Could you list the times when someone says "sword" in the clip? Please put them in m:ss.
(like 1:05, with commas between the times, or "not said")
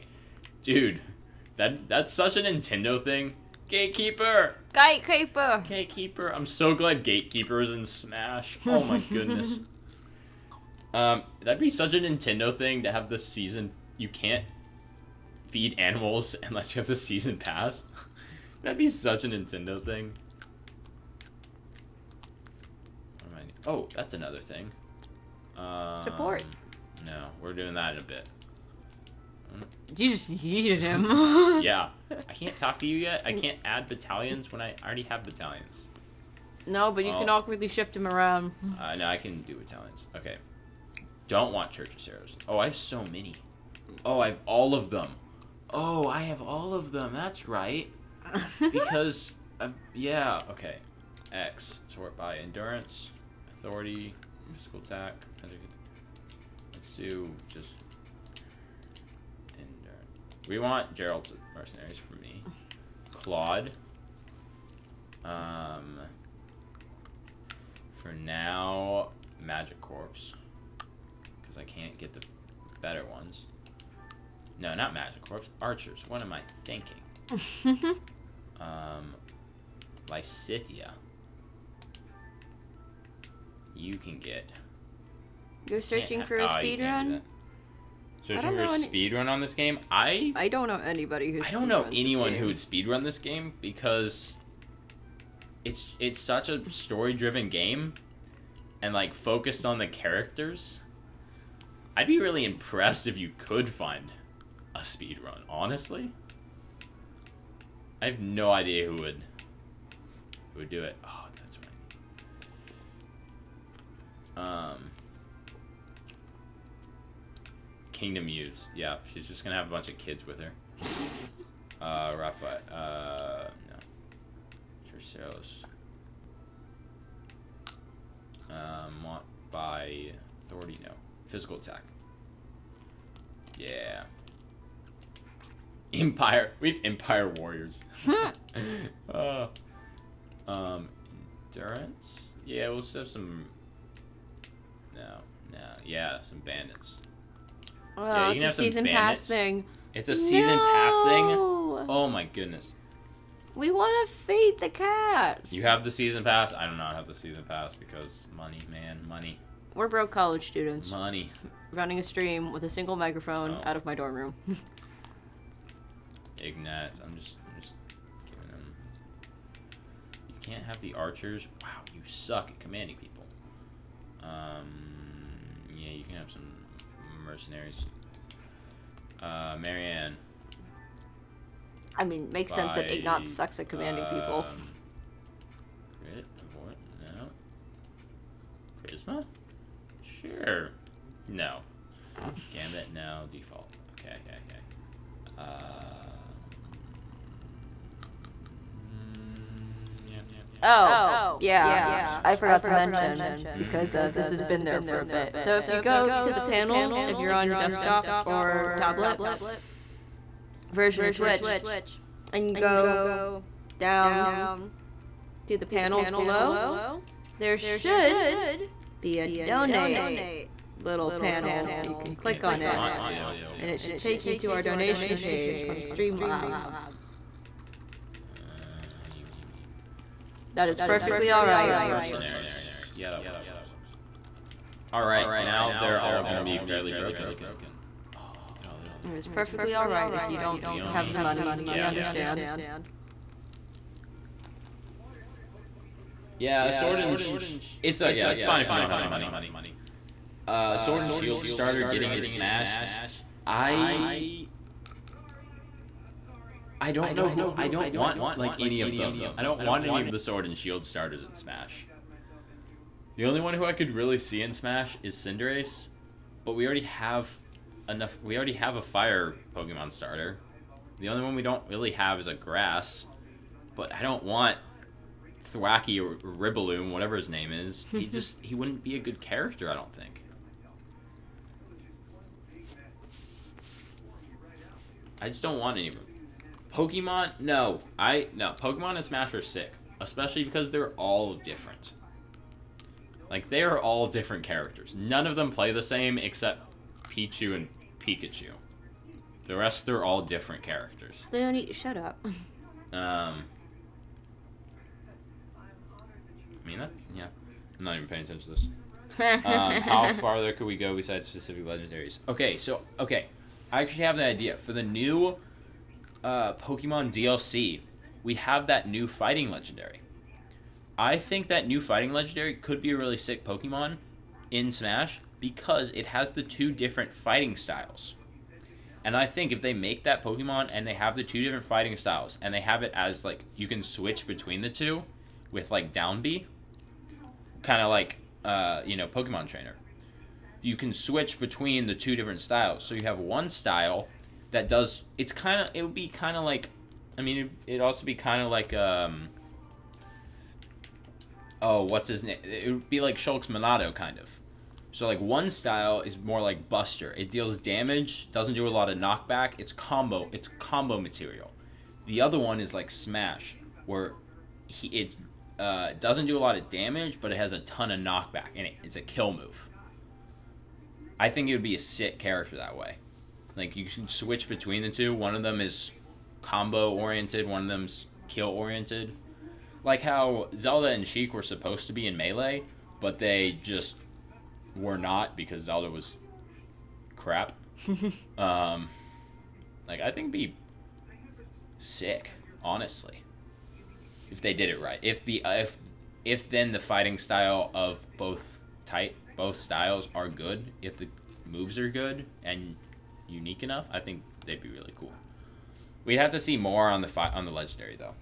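4:06, 4:10, 4:20.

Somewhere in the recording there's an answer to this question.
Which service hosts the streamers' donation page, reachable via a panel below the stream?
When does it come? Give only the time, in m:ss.
3:45.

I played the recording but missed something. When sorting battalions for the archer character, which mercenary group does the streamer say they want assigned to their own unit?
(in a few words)
Jeralt's mercenaries.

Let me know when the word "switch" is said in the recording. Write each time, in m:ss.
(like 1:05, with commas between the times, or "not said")
5:33, 5:40, 6:14.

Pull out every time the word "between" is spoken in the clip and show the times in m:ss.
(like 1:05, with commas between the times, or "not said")
5:34, 5:41, 6:14.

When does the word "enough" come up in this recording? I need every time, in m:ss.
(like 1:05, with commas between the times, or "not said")
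4:27, 6:43.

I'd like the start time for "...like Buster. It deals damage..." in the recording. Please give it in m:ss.
5:56.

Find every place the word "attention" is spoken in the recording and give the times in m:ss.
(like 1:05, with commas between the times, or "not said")
5:08.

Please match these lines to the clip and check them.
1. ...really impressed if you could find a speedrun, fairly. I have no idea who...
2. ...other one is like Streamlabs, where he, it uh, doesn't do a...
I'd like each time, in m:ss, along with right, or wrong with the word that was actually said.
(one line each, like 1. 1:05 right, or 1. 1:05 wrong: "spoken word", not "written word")
1. 1:42 wrong: "honestly", not "fairly"
2. 6:02 wrong: "Smash", not "Streamlabs".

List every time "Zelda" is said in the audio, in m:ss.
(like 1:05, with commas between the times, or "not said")
6:20, 6:25.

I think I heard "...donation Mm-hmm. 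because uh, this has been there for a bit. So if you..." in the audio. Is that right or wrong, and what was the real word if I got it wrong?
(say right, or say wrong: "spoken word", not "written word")
wrong: "mention", not "donation".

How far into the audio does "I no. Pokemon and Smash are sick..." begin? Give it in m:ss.
4:47.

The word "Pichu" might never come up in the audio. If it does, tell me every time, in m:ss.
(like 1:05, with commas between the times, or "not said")
4:57.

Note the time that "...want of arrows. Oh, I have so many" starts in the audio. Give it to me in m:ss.
0:41.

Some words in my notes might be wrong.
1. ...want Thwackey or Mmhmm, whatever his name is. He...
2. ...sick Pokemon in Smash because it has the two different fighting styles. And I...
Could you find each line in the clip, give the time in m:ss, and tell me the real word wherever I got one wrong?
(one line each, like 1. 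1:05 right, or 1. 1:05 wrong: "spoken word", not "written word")
1. 4:34 wrong: "Ribbaloom", not "Mmhmm"
2. 5:23 right.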